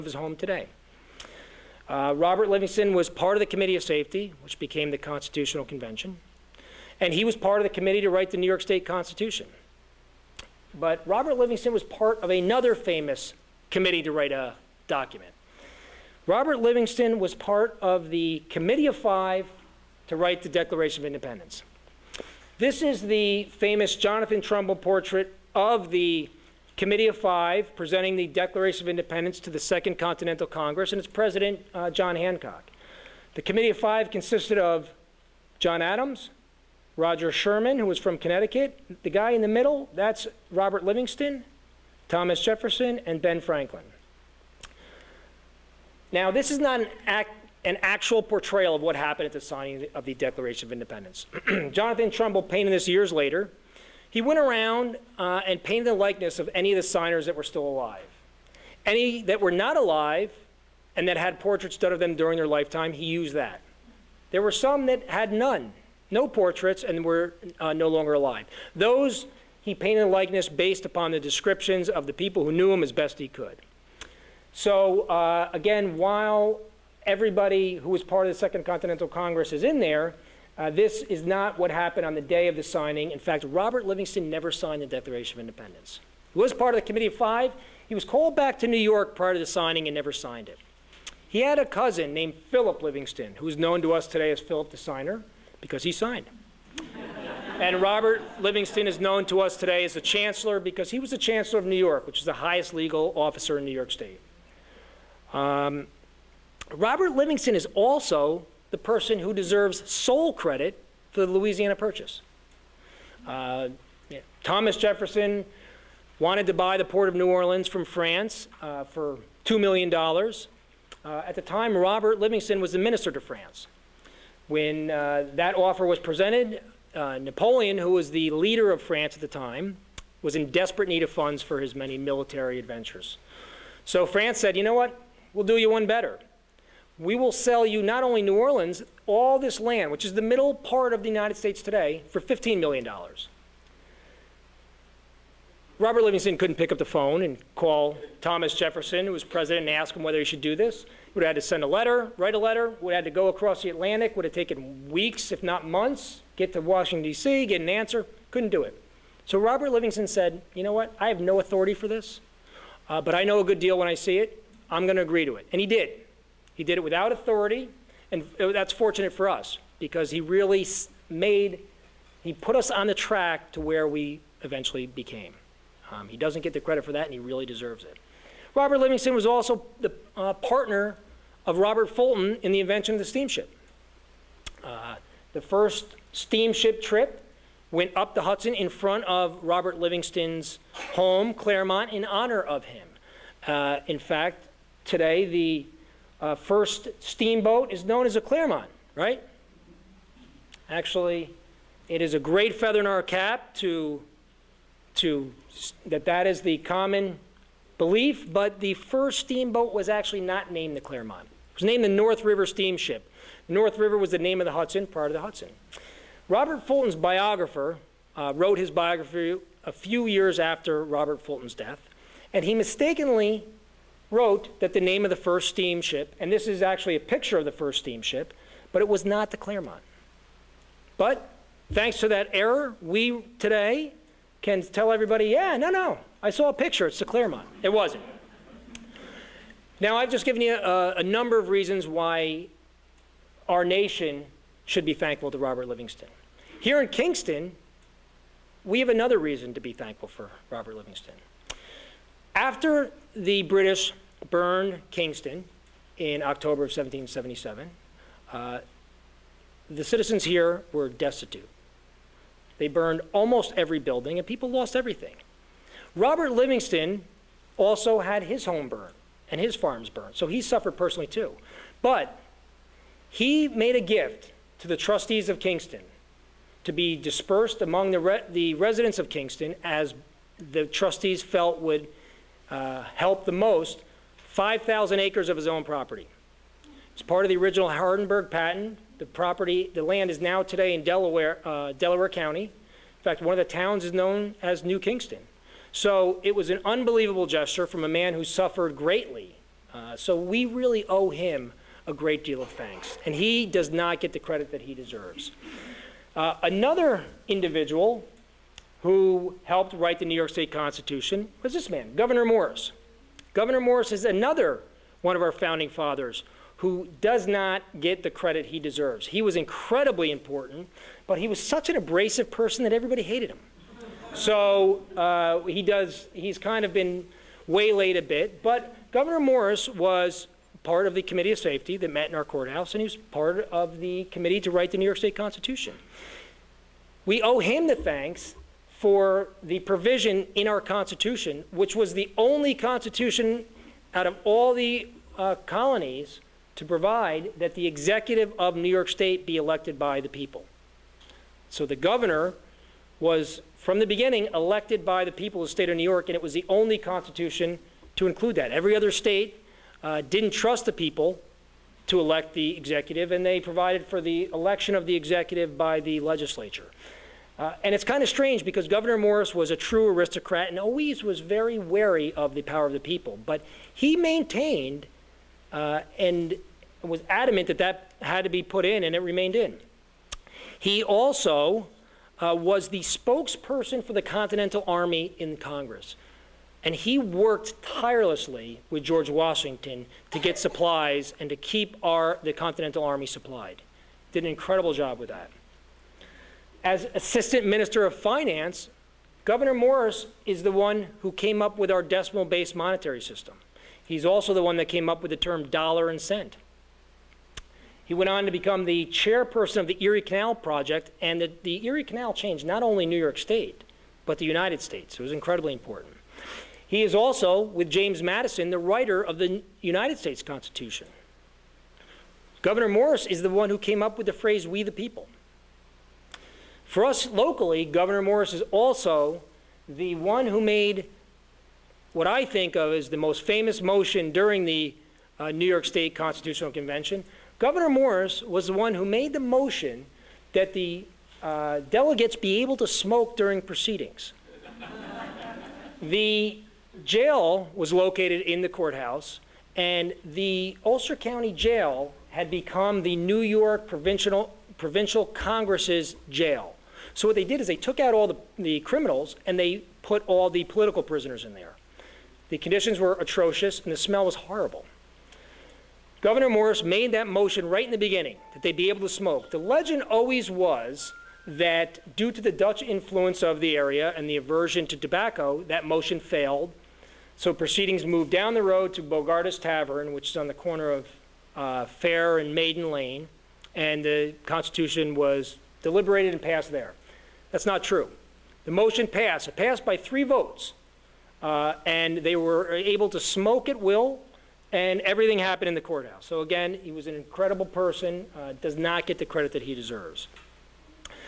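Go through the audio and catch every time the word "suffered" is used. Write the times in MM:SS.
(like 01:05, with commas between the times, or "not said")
04:30, 04:58.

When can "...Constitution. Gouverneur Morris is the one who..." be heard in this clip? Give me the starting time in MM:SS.
07:00.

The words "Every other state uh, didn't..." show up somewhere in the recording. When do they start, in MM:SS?
05:58.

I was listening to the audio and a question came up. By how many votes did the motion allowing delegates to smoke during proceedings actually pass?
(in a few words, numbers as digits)
3 votes.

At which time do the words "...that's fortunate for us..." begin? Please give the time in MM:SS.
02:48.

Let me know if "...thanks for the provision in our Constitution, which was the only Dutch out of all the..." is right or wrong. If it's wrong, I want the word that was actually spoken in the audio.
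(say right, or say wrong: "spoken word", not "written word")
wrong: "Constitution", not "Dutch".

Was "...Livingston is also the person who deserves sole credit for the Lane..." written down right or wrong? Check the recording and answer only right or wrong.
wrong.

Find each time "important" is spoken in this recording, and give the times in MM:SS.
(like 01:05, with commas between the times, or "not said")
05:20, 06:55.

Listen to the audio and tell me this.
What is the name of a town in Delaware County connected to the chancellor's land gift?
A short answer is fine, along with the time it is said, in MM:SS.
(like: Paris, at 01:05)
New Kingston, at 04:54.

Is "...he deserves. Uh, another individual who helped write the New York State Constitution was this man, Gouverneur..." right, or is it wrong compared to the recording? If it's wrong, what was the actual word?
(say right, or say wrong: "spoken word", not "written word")
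right.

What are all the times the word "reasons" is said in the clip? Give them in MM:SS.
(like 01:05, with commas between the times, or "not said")
04:01, 04:09.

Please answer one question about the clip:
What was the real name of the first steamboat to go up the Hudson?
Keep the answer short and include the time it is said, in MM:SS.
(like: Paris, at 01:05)
North River Steamship, at 03:31.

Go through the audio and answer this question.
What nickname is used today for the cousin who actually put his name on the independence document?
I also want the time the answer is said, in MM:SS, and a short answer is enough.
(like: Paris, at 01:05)
Philip the Signer, at 01:34.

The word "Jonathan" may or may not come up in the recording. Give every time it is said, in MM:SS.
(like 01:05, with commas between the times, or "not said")
00:23, 00:51.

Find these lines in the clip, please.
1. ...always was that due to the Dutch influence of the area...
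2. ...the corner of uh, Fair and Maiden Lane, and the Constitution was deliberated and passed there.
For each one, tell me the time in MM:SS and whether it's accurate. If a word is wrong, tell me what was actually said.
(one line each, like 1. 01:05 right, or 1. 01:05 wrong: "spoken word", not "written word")
1. 07:49 right
2. 08:00 right.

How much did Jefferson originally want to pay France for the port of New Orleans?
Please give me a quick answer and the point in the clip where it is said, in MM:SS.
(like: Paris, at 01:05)
$2 million, at 01:59.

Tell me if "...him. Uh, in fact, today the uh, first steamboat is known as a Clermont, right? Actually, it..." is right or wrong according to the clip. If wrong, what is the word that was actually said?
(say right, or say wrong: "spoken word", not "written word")
right.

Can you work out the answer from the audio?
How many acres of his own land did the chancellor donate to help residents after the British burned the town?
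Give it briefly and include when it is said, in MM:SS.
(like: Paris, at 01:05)
5,000 acres, at 04:44.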